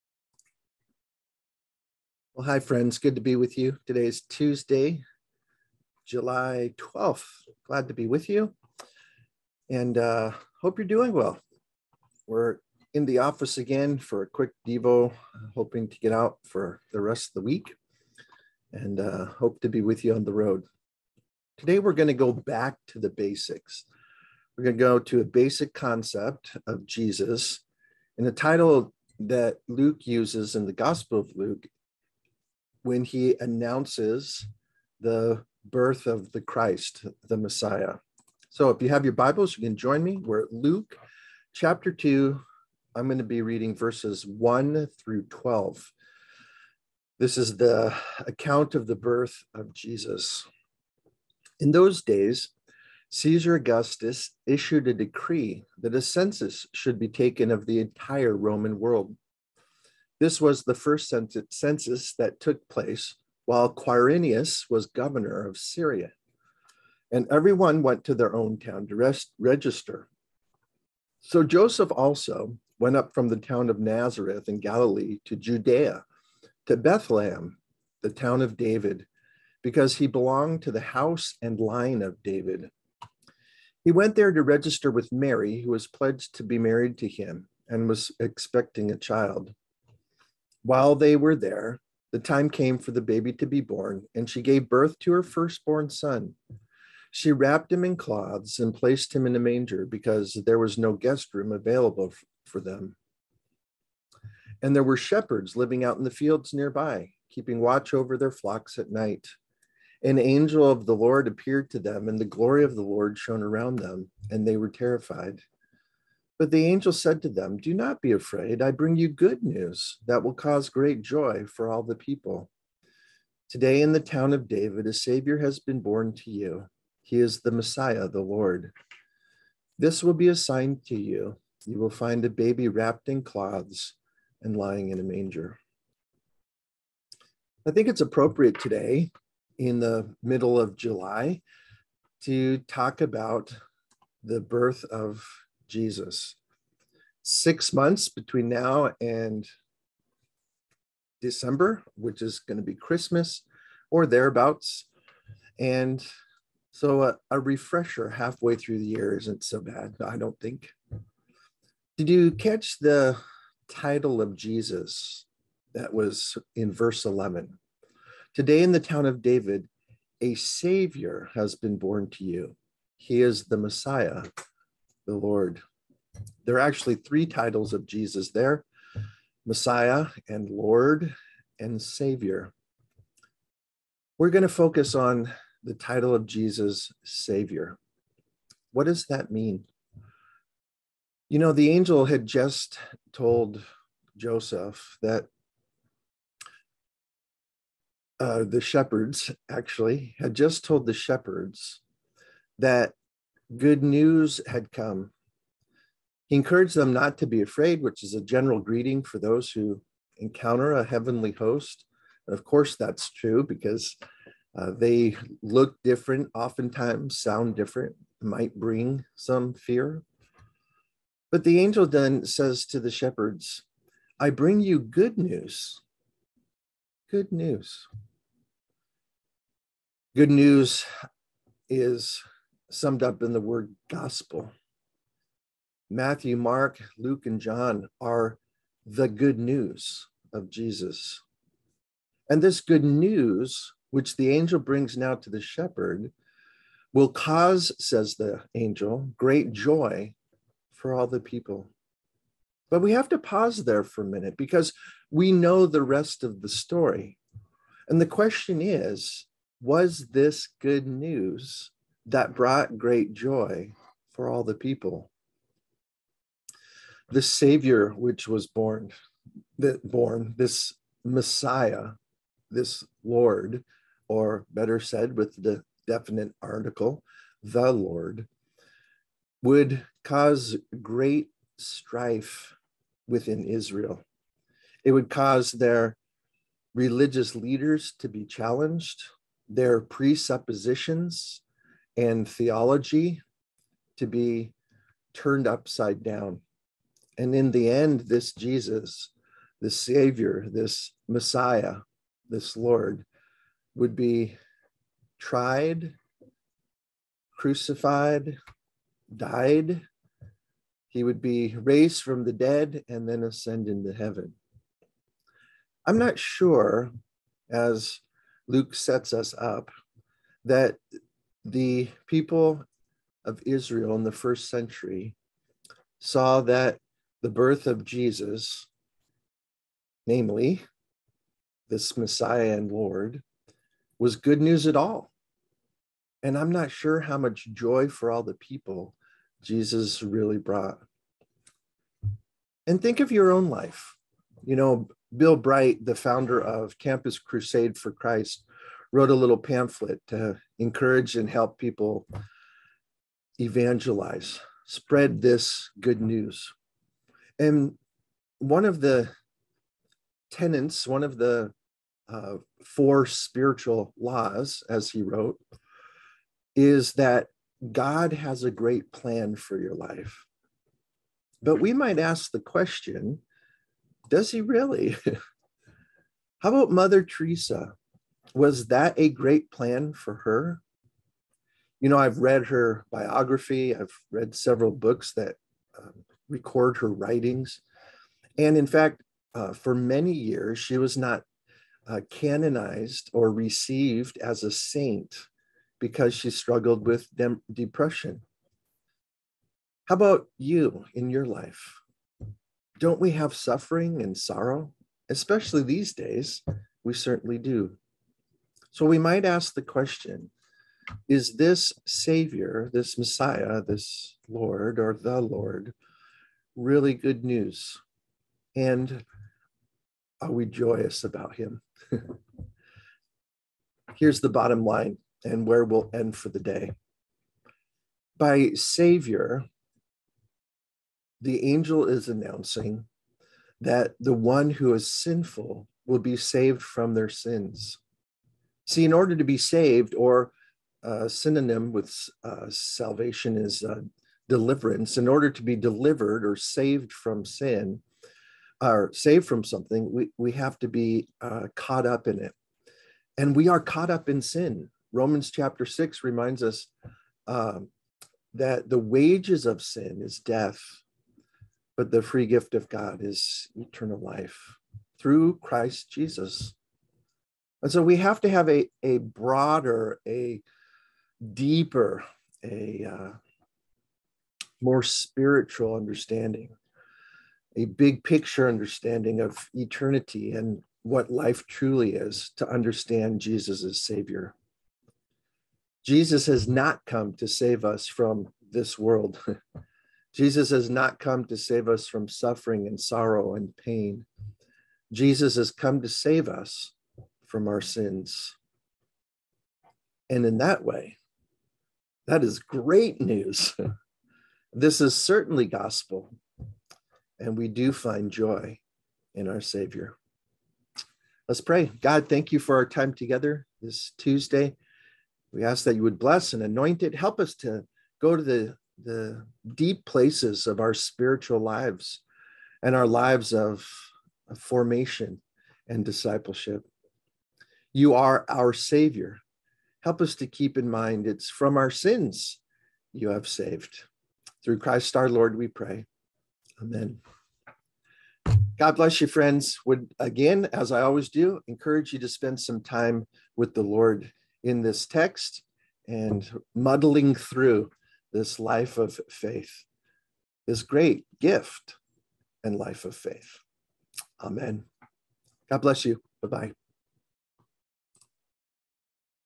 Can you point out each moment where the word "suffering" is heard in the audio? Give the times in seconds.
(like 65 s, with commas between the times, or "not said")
403 s, 492 s.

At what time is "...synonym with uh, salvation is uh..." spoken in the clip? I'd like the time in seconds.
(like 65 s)
441 s.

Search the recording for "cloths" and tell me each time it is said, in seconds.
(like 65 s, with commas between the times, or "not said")
97 s, 133 s.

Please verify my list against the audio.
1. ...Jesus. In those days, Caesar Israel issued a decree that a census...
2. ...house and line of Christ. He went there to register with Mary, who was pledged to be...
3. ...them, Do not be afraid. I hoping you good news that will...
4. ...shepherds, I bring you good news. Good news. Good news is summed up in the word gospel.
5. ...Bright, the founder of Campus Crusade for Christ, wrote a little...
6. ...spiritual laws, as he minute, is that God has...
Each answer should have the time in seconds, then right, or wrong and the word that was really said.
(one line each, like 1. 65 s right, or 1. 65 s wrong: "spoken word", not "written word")
1. 49 s wrong: "Augustus", not "Israel"
2. 80 s wrong: "David", not "Christ"
3. 117 s wrong: "bring", not "hoping"
4. 222 s right
5. 345 s right
6. 363 s wrong: "wrote", not "minute".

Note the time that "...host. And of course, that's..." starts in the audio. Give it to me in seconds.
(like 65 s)
211 s.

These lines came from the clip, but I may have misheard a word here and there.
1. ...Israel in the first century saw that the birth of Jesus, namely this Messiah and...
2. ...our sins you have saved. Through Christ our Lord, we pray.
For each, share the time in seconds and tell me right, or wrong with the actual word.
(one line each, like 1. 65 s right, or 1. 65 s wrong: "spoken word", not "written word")
1. 323 s right
2. 531 s right.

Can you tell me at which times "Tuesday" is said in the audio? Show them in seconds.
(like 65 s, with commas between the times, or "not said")
4 s, 513 s.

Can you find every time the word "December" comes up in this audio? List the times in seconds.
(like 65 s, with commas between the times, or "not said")
151 s.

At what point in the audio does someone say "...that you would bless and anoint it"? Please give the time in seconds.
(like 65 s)
515 s.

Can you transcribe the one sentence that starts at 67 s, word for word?
And everyone went to their own town to rest, register.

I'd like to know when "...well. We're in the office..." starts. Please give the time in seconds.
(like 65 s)
11 s.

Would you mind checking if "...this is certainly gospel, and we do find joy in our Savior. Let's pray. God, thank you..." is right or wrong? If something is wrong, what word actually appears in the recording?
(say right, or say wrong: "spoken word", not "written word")
right.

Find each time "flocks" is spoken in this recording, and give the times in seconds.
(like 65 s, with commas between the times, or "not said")
108 s.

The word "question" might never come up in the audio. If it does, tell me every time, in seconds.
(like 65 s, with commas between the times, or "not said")
258 s, 372 s, 409 s.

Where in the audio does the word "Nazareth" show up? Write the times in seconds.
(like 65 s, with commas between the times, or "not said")
73 s.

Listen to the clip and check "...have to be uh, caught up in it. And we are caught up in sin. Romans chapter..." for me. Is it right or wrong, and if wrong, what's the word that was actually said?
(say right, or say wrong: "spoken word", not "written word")
right.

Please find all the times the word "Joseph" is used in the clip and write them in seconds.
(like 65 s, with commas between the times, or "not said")
71 s, 194 s.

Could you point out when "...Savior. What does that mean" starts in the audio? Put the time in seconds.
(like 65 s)
187 s.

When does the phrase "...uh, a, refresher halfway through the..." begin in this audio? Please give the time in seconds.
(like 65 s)
157 s.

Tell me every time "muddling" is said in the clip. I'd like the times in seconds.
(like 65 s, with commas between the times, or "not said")
546 s.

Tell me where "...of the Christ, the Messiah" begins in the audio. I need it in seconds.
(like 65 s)
36 s.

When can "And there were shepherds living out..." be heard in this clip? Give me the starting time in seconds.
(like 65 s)
104 s.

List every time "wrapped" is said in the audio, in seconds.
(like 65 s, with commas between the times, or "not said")
97 s, 132 s.